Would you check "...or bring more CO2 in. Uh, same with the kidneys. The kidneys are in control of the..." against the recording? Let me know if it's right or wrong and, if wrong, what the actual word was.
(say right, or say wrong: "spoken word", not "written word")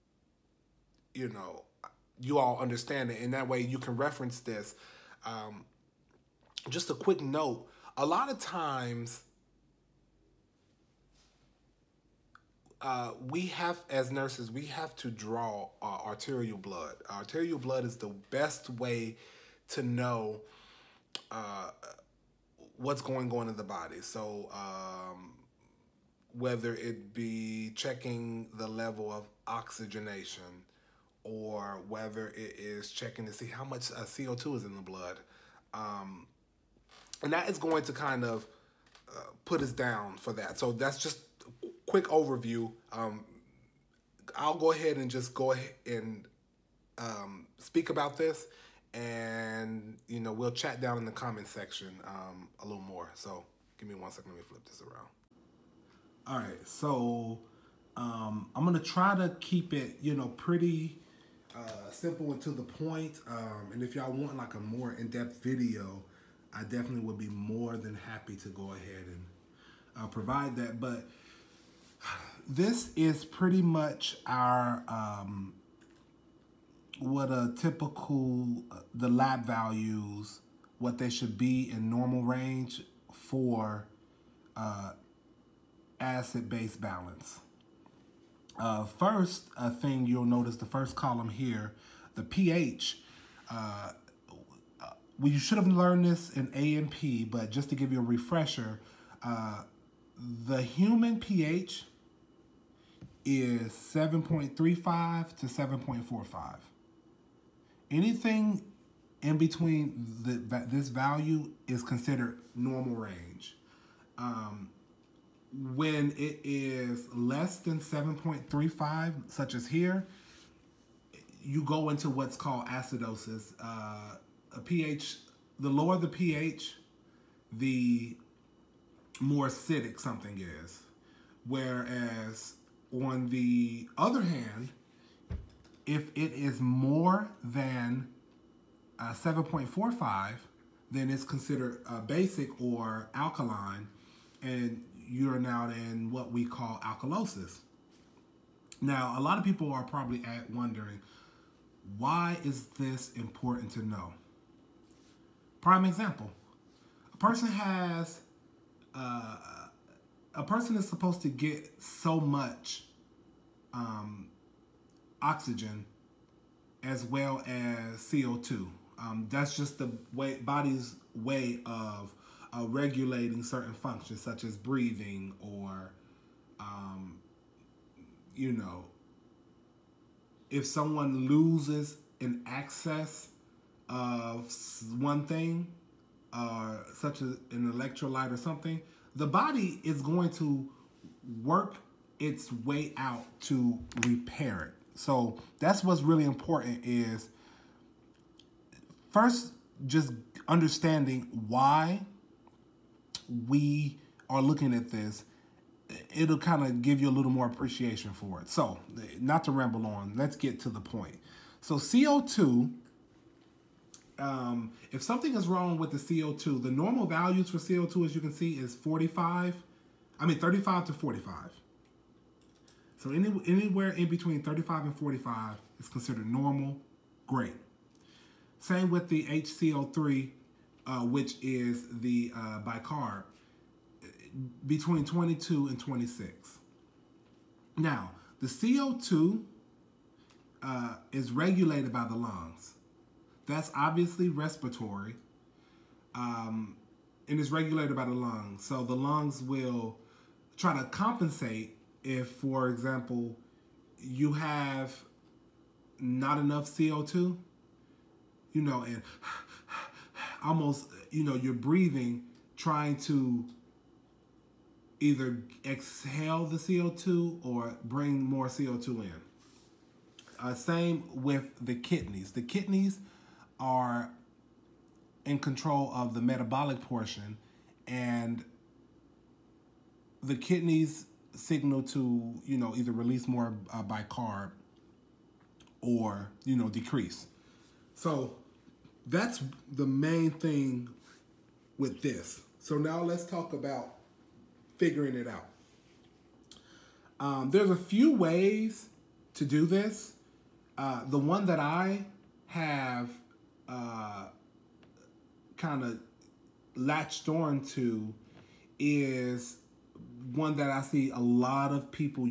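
right.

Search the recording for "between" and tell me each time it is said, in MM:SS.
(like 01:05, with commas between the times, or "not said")
01:49, 03:44, 03:54.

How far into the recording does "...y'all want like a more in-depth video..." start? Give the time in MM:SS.
01:03.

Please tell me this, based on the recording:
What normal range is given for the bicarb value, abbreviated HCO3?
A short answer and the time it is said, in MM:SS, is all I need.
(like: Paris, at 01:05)
22 to 26, at 03:54.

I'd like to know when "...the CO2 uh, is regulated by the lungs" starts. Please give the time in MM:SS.
03:58.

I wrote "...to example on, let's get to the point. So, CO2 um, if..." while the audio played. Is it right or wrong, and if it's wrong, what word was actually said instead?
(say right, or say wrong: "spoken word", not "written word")
wrong: "ramble", not "example".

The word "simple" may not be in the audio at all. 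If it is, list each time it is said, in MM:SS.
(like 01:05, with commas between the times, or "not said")
01:01.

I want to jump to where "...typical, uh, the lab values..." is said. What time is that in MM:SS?
01:17.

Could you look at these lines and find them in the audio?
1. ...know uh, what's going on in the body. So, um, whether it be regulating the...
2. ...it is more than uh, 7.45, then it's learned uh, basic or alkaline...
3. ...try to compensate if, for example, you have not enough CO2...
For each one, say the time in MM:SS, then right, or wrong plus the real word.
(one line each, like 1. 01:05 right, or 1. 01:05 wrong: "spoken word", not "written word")
1. 00:19 wrong: "checking", not "regulating"
2. 02:16 wrong: "considered", not "learned"
3. 04:10 right.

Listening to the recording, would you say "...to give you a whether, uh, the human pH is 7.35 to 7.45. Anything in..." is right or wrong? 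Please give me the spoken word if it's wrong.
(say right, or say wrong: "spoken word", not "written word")
wrong: "refresher", not "whether".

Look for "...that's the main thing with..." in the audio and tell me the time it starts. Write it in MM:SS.
04:49.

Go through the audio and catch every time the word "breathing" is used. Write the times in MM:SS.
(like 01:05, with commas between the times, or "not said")
02:54, 04:21.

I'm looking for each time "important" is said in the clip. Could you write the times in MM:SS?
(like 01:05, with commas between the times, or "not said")
02:33, 03:16.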